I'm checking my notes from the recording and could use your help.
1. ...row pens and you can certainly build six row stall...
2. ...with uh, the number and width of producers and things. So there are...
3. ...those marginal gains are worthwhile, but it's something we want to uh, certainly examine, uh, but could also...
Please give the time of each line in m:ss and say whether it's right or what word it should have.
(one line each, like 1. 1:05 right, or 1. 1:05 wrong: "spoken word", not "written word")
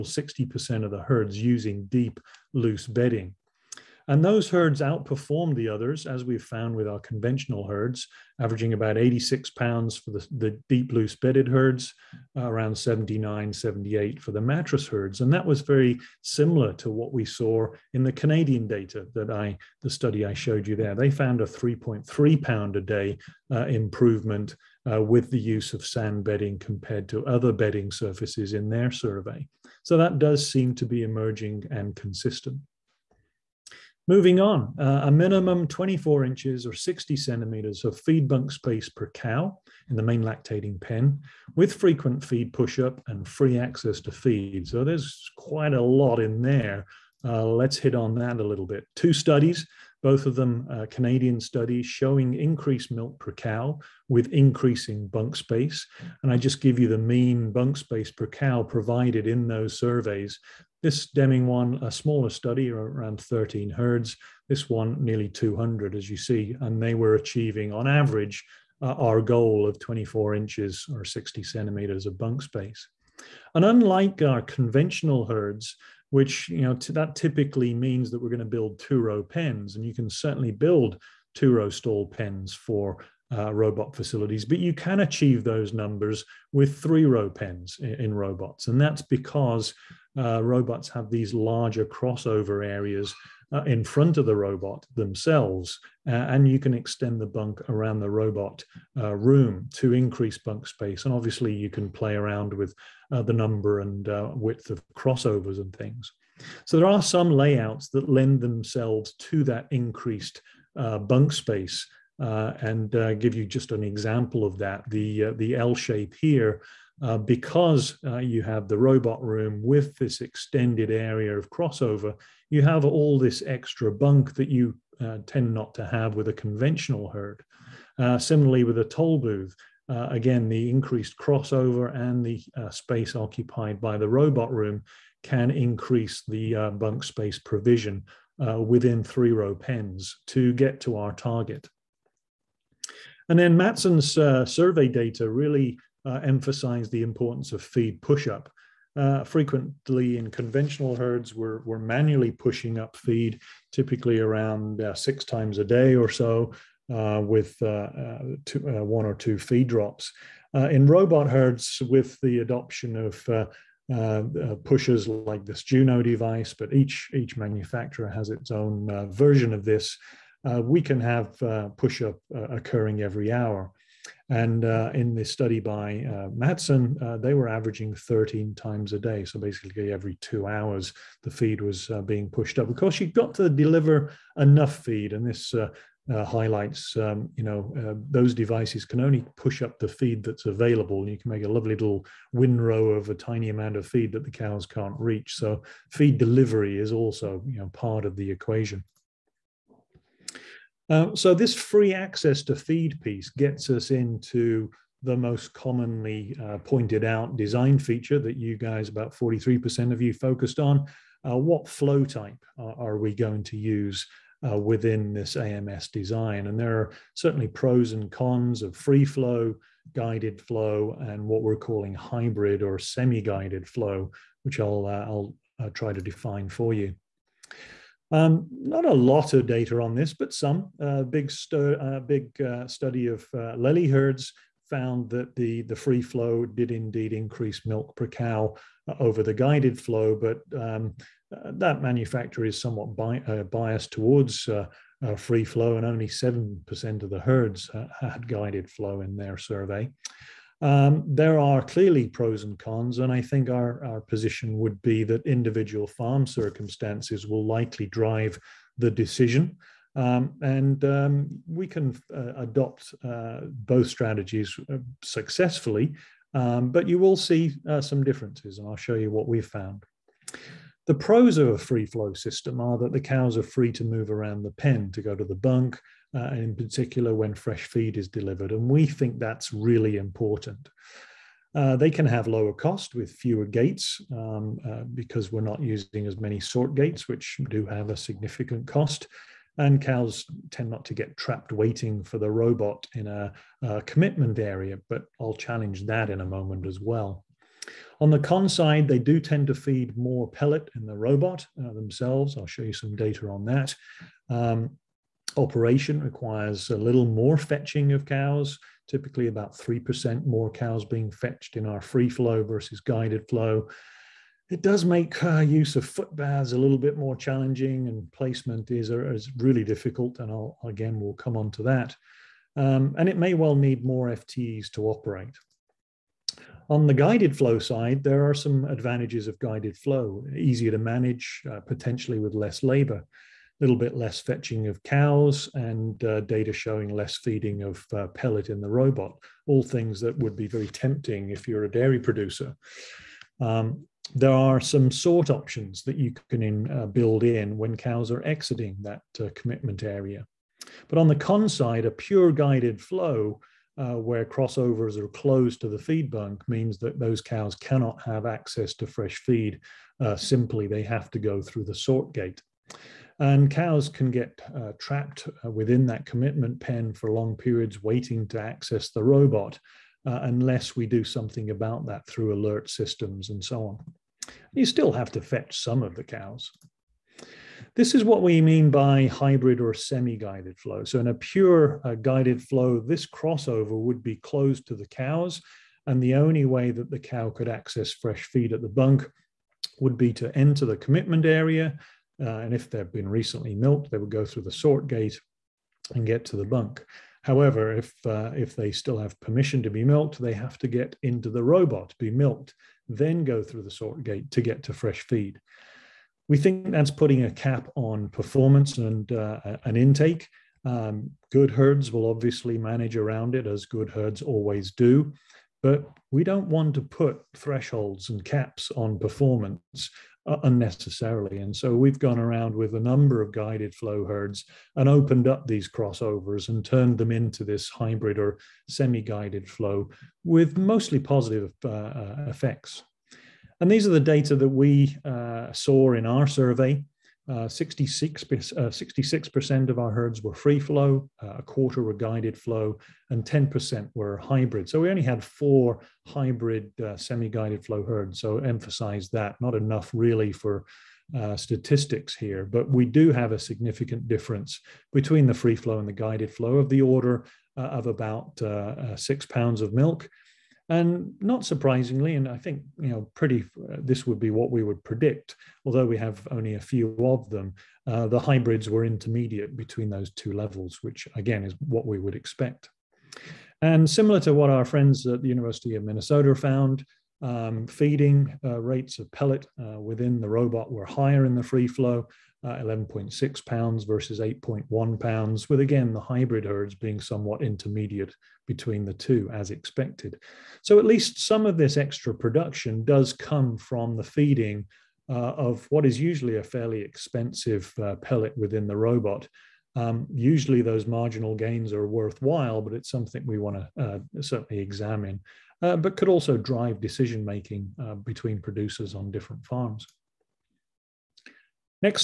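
1. 1:19 wrong: "two", not "six"
2. 1:42 wrong: "crossovers", not "producers"
3. 8:20 right.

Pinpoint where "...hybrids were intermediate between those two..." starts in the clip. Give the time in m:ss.
7:48.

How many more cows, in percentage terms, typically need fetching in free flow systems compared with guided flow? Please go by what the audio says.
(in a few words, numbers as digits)
3%.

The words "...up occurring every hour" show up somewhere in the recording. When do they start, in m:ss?
2:52.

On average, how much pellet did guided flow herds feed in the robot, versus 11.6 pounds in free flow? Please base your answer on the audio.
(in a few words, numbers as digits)
8.1 pounds.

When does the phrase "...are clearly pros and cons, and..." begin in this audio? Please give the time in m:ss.
4:11.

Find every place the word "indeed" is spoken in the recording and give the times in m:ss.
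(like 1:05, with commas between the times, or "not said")
3:56.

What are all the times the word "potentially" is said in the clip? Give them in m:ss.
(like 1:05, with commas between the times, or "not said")
5:31.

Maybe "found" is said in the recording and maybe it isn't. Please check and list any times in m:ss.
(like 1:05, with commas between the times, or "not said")
0:06, 0:21, 3:54, 4:29, 7:56.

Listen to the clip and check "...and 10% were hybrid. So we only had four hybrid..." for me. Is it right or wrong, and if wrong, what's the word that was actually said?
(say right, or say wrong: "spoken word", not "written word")
right.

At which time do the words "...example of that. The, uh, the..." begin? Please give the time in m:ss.
1:53.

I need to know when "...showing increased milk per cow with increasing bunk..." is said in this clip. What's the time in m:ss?
0:51.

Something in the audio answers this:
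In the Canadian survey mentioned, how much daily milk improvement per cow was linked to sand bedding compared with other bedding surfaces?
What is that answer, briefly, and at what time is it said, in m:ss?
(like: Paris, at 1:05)
3.3 pounds, at 0:21.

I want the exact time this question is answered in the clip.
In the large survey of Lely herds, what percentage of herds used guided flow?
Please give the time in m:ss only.
4:06.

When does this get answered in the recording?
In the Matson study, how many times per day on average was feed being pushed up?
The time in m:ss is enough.
2:57.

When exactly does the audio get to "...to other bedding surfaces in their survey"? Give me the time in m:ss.
0:27.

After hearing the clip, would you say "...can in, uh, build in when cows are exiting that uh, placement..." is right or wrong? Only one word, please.
wrong.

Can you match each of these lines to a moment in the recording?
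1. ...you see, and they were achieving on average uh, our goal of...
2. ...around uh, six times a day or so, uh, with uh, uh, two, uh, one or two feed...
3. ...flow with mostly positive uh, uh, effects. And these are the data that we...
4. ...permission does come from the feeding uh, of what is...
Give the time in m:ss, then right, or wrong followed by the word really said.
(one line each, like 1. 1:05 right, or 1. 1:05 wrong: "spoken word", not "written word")
1. 1:06 right
2. 2:34 right
3. 7:09 right
4. 8:12 wrong: "production", not "permission".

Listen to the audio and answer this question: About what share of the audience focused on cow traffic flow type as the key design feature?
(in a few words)
43%.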